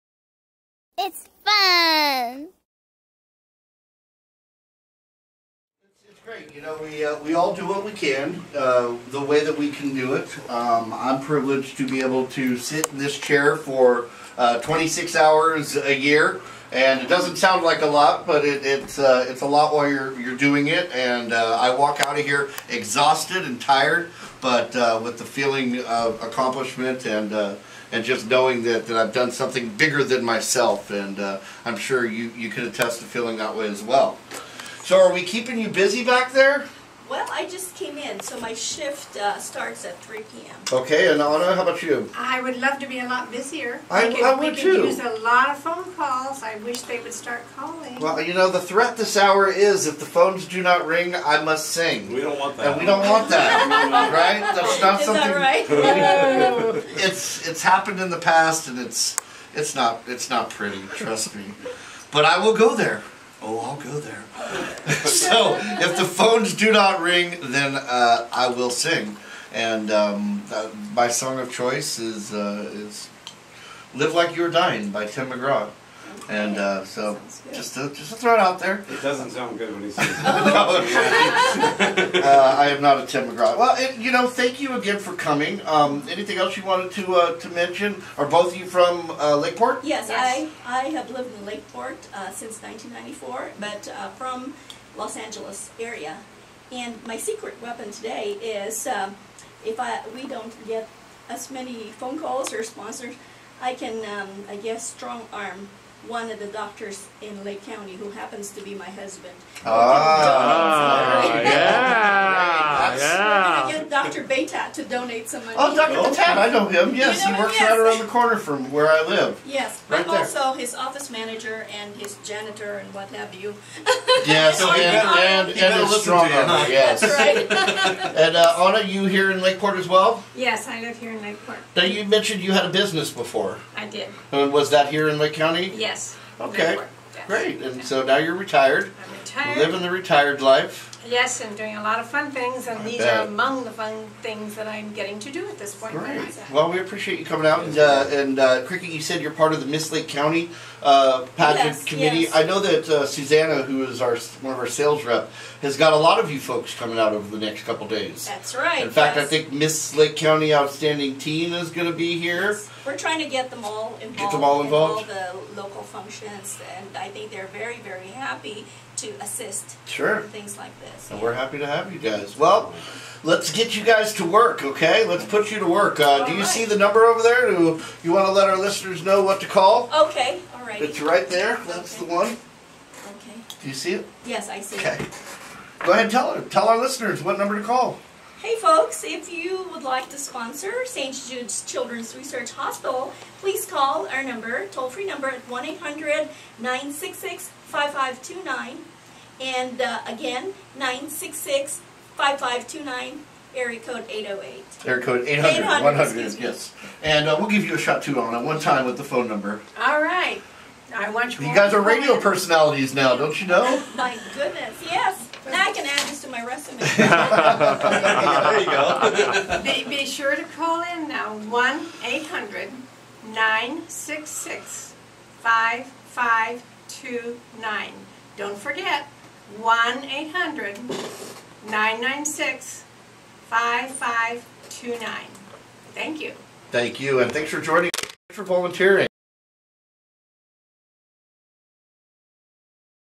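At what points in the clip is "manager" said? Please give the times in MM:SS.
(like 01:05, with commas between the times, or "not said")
02:01.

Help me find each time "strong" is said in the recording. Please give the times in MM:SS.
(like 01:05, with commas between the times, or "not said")
01:44, 02:06.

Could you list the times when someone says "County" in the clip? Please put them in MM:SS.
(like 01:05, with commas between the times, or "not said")
01:47, 02:15, 02:30, 02:40.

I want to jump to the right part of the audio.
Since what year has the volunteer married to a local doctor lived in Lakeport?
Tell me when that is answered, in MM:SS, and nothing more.
01:32.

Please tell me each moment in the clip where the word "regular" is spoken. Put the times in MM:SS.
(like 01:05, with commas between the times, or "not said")
not said.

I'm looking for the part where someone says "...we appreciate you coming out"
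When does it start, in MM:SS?
02:26.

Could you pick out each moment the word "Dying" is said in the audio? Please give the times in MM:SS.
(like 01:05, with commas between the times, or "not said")
01:14.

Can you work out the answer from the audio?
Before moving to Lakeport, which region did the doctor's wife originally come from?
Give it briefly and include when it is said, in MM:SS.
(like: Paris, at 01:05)
Los Angeles area, at 01:34.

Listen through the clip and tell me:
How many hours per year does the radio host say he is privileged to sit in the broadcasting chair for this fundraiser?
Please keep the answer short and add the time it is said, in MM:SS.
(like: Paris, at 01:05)
26, at 00:14.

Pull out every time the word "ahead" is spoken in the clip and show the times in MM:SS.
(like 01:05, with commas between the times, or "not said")
03:05.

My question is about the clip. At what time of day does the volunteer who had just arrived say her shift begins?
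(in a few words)
3 p.m.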